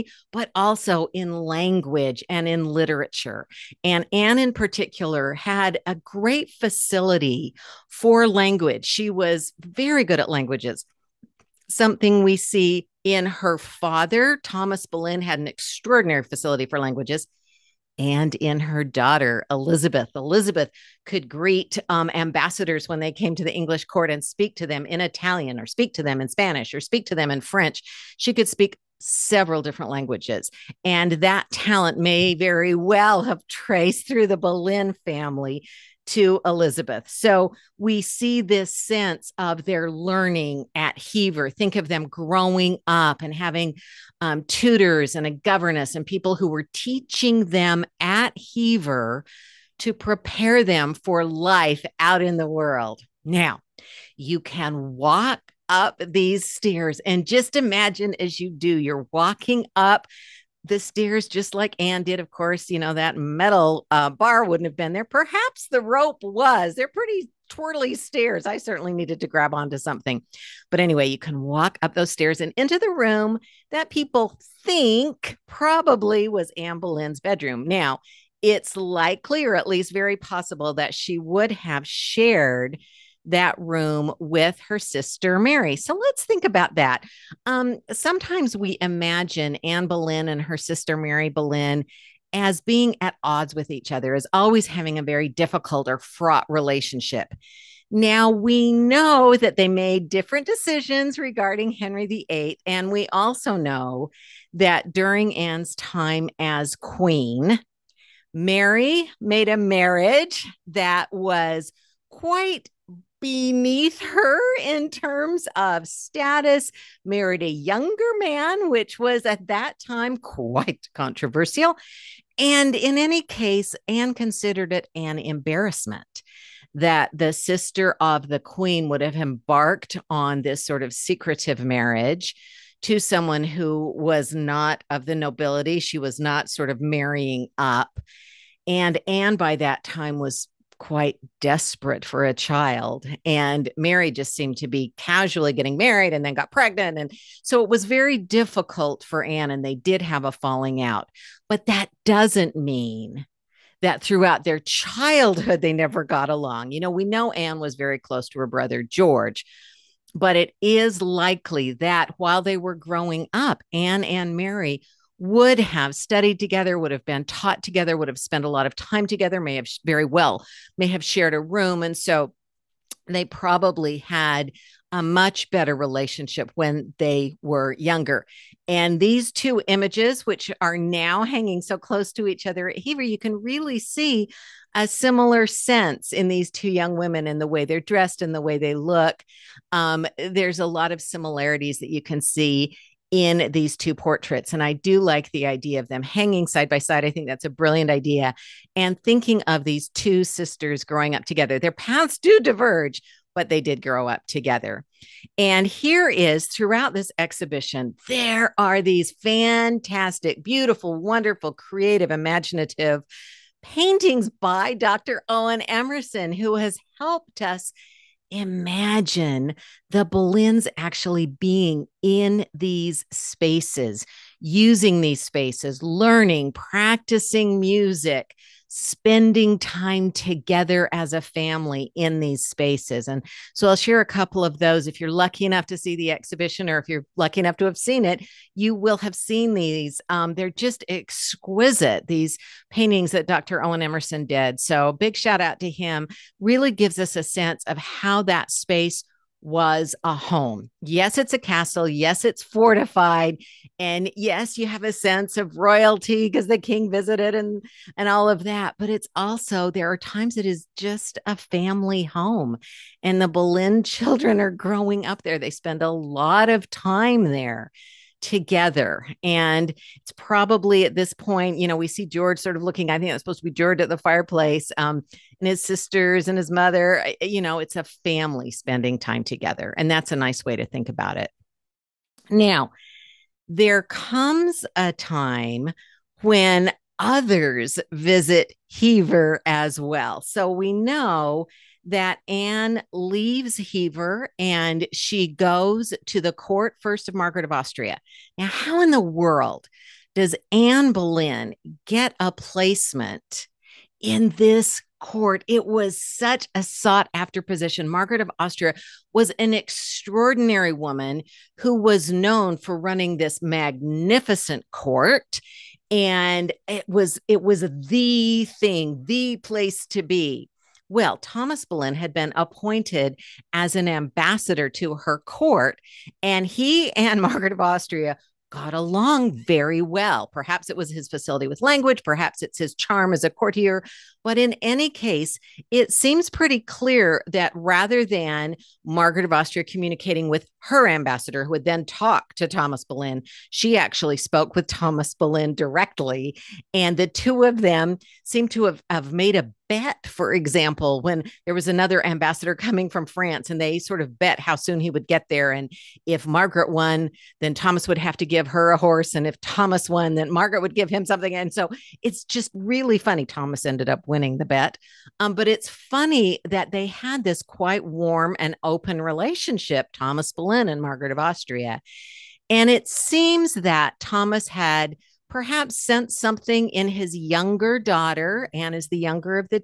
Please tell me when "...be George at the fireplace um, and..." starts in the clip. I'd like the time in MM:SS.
04:33.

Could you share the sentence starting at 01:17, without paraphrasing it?
Now, it's likely, or at least very possible, that she would have shared that room with her sister Mary.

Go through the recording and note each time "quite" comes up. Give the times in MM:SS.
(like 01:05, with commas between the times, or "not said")
01:52, 02:00, 02:20, 06:07.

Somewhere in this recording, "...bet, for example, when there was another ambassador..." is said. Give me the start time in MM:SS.
05:49.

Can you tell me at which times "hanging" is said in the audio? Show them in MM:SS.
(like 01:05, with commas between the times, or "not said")
03:01, 03:16.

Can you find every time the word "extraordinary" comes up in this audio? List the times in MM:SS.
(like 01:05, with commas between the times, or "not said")
00:15, 05:09.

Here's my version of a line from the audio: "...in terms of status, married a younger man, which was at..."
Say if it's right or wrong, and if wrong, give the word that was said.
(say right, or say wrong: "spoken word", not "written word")
right.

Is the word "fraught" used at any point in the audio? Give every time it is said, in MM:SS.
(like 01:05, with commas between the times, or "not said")
01:35.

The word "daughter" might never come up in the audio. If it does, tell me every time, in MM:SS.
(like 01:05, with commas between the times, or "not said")
00:18, 06:17.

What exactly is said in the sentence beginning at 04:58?
Now, how in the world does Anne Boleyn get a placement in this court?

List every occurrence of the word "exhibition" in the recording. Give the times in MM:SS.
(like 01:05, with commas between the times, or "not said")
03:27, 03:56.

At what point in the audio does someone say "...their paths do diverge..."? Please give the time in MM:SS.
03:21.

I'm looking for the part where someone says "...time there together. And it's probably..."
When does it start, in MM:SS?
04:26.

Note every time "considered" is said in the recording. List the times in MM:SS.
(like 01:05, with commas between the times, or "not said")
02:04.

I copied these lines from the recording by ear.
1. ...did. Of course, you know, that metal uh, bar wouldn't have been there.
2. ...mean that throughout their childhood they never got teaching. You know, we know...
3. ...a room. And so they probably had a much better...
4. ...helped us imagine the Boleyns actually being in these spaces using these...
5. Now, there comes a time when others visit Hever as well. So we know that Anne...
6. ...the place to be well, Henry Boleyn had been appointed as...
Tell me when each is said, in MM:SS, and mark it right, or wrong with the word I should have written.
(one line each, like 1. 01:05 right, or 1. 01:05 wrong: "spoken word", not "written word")
1. 01:02 right
2. 02:32 wrong: "along", not "teaching"
3. 02:51 right
4. 03:36 right
5. 04:42 right
6. 05:19 wrong: "Thomas", not "Henry".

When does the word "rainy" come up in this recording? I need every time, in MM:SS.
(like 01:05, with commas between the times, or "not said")
not said.